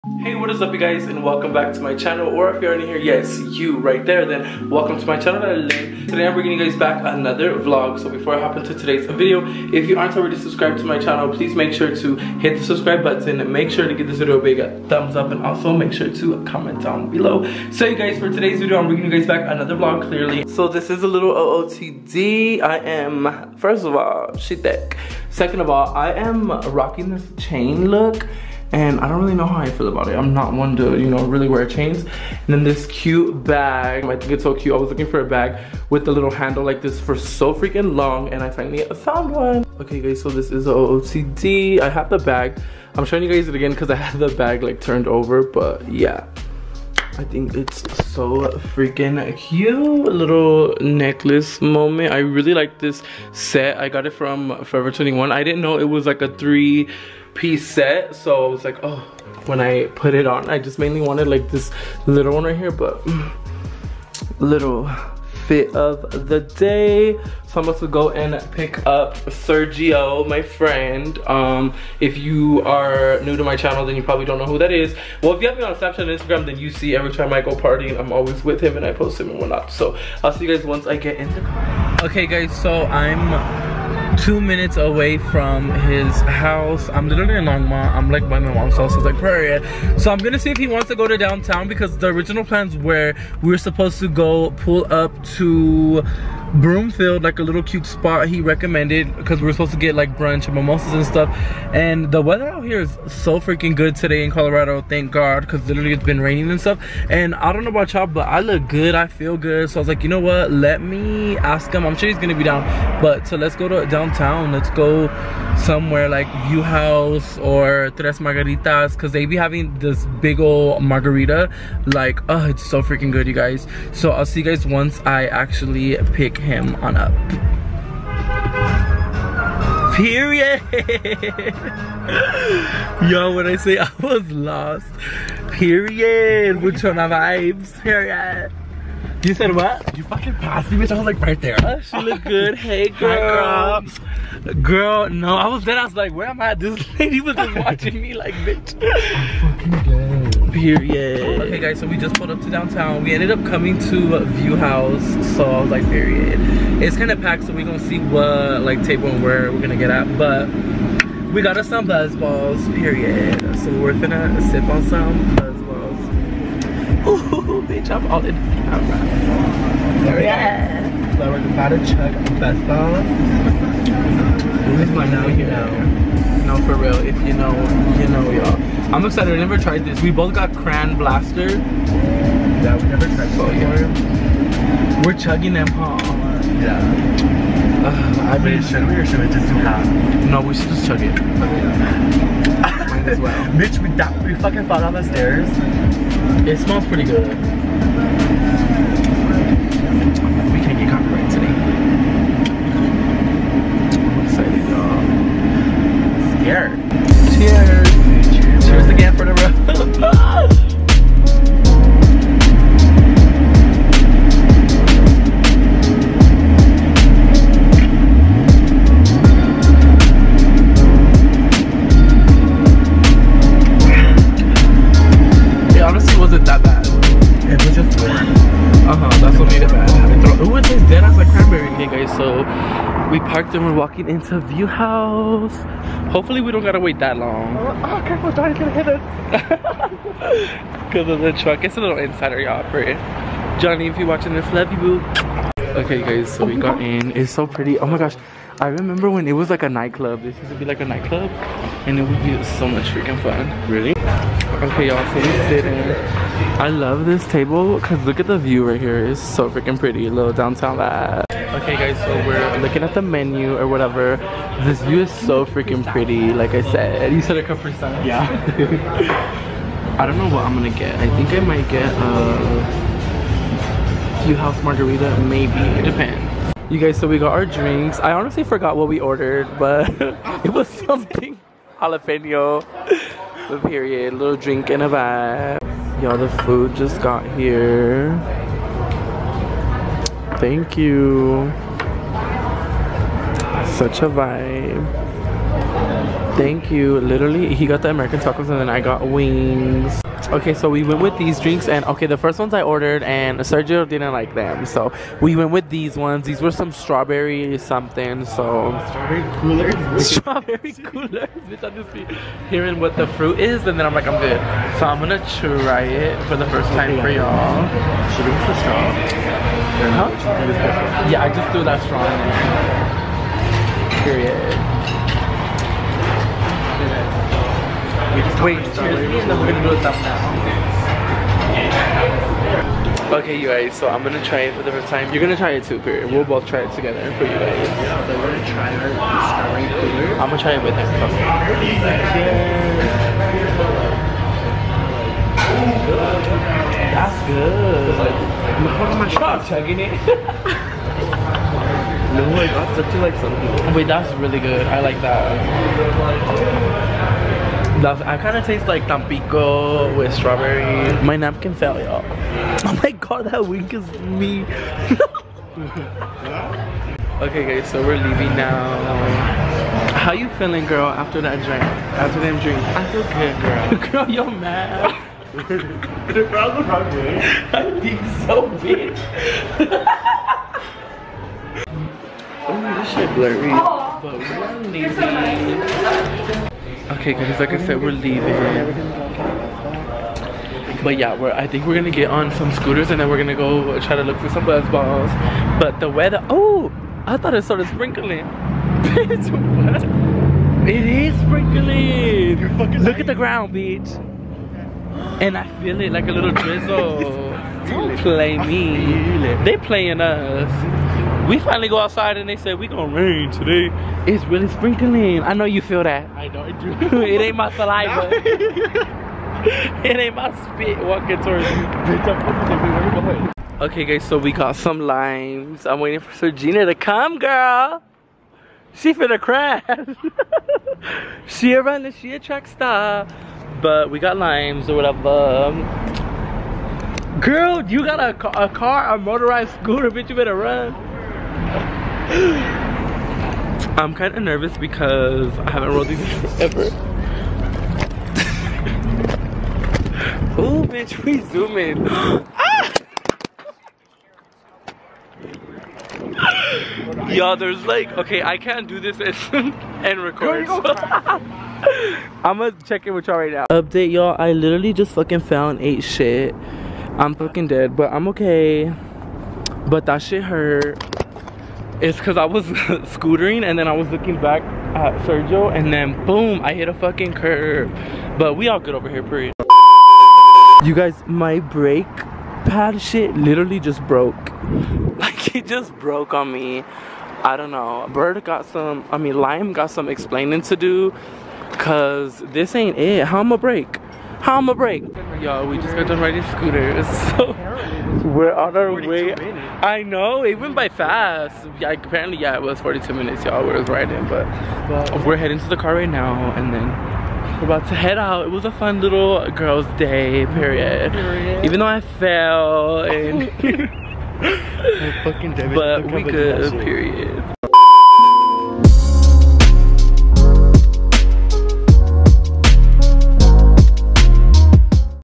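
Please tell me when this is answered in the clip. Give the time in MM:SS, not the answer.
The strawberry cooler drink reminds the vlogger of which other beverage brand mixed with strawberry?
05:58.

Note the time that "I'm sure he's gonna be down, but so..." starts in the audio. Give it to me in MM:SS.
01:51.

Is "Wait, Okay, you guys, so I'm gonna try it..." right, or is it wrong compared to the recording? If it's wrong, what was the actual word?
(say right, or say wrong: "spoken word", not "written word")
right.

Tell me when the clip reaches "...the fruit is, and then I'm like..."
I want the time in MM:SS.
05:12.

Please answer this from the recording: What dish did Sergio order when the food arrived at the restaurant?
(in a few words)
American tacos.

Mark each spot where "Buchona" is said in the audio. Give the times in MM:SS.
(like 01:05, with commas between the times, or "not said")
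02:16.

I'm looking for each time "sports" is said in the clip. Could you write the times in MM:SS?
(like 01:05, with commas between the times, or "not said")
not said.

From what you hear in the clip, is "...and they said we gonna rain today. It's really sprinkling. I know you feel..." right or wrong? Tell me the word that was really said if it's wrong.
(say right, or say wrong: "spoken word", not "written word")
right.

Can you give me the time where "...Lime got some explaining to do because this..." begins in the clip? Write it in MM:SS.
08:09.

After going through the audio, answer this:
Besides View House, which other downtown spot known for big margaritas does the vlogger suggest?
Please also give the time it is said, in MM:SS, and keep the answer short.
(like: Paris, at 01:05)
Tres Margaritas, at 01:57.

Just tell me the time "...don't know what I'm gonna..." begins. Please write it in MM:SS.
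04:30.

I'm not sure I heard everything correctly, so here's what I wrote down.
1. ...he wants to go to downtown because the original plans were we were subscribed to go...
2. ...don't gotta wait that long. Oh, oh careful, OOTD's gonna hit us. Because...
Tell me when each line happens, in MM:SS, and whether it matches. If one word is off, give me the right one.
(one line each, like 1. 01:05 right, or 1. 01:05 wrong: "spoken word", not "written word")
1. 01:30 wrong: "supposed", not "subscribed"
2. 03:56 wrong: "Johnny", not "OOTD".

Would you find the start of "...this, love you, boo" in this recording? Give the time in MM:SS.
04:04.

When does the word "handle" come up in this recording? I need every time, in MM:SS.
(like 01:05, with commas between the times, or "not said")
00:36.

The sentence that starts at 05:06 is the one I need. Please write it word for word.
These were some strawberry something, so strawberry coolers.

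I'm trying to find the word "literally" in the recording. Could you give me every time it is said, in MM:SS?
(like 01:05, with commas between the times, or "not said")
01:27, 01:45, 04:57, 07:44, 08:03.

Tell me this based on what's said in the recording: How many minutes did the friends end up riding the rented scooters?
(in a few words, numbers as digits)
42.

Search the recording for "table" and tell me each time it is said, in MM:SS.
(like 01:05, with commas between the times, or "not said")
02:38, 04:17.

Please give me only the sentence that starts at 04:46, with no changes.
Y'all, the food just got here.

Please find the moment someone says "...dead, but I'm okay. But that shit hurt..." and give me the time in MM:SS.
07:47.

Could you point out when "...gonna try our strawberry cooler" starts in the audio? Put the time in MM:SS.
05:38.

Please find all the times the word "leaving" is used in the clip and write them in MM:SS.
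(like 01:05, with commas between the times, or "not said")
06:07, 06:27.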